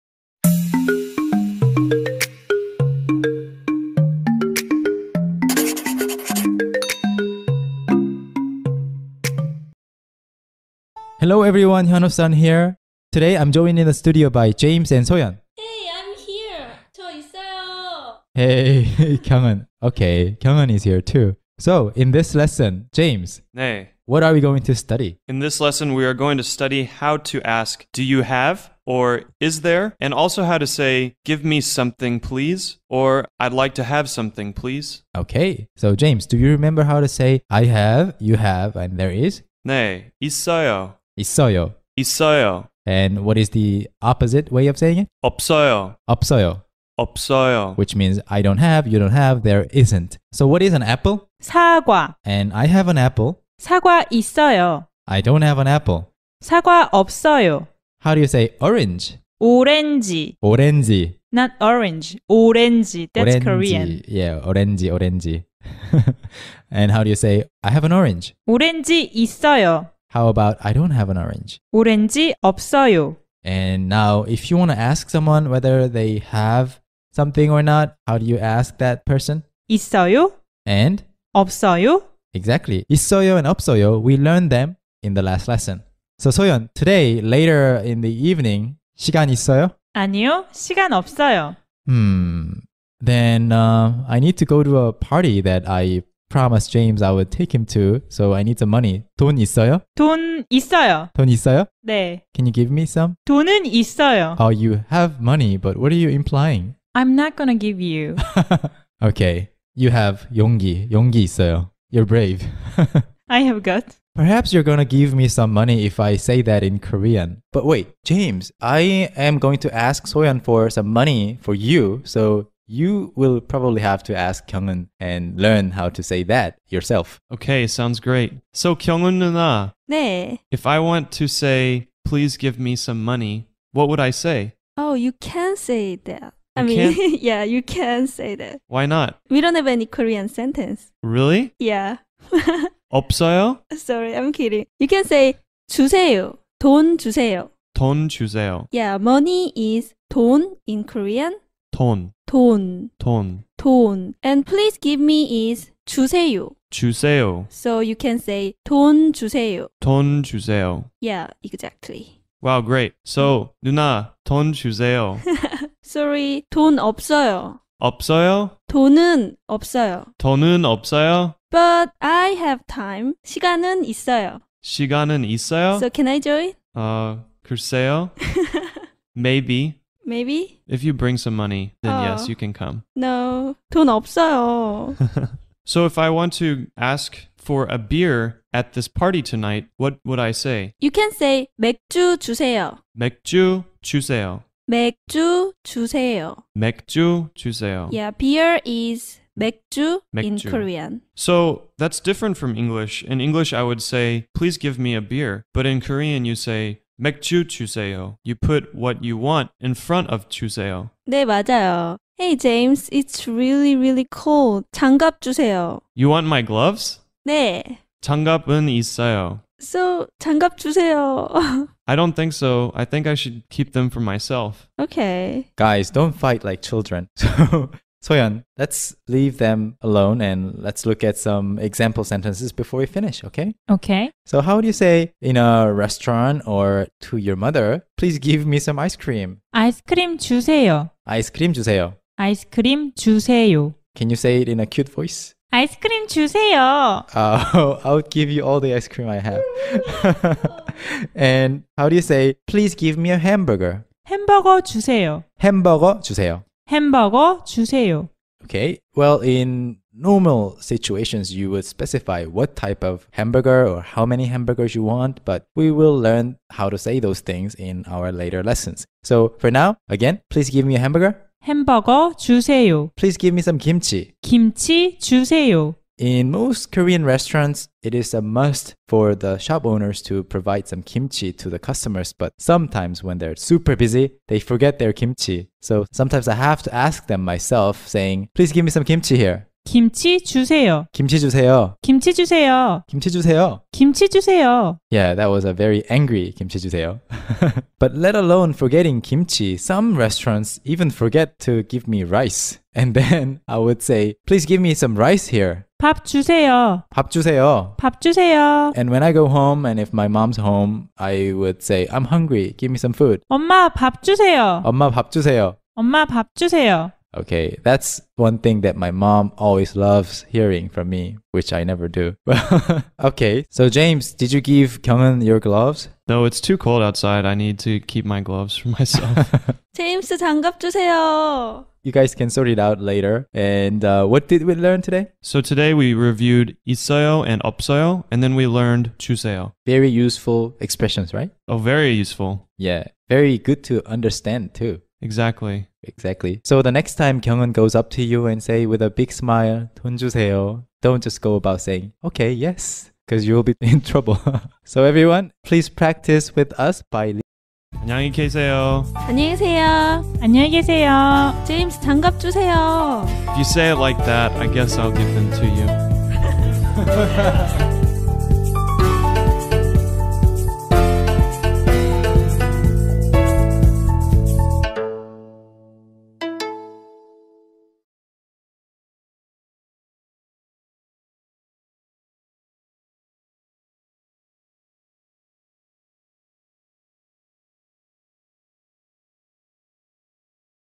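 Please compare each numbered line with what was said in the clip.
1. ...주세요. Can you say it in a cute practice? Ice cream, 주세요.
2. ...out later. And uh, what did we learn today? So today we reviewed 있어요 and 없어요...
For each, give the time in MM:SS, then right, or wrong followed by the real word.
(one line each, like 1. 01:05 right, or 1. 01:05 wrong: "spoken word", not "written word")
1. 04:02 wrong: "voice", not "practice"
2. 05:32 right.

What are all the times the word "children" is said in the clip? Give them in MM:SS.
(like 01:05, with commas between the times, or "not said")
03:46.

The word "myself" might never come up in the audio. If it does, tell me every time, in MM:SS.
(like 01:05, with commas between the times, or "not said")
03:44, 04:47, 05:28.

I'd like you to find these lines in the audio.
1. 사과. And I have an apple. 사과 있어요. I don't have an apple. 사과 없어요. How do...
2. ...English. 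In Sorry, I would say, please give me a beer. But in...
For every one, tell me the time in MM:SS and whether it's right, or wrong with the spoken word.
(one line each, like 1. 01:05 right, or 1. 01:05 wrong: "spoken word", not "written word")
1. 00:51 right
2. 03:22 wrong: "English", not "Sorry".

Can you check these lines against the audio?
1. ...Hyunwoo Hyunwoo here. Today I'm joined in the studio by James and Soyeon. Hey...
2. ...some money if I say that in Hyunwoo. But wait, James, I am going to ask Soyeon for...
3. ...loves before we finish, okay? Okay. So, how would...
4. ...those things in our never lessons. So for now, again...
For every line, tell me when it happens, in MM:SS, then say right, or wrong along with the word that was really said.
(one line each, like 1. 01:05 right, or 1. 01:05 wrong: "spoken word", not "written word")
1. 00:11 wrong: "Sun", not "Hyunwoo"
2. 01:55 wrong: "Korean", not "Hyunwoo"
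3. 03:52 wrong: "sentences", not "loves"
4. 04:26 wrong: "later", not "never".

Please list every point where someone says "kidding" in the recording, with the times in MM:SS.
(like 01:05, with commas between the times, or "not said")
02:24.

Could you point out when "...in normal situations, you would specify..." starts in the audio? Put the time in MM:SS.
04:19.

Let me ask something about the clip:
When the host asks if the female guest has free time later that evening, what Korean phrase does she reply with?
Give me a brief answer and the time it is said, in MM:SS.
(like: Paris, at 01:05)
아니요, 시간 없어요, at 01:29.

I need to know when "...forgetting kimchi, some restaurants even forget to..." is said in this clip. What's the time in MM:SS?
04:58.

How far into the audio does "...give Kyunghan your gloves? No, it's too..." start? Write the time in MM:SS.
05:24.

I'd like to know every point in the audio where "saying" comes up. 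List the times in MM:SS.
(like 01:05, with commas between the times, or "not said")
00:44, 04:47, 05:51.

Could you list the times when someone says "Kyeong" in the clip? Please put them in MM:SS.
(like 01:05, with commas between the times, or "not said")
02:04, 02:08, 05:47.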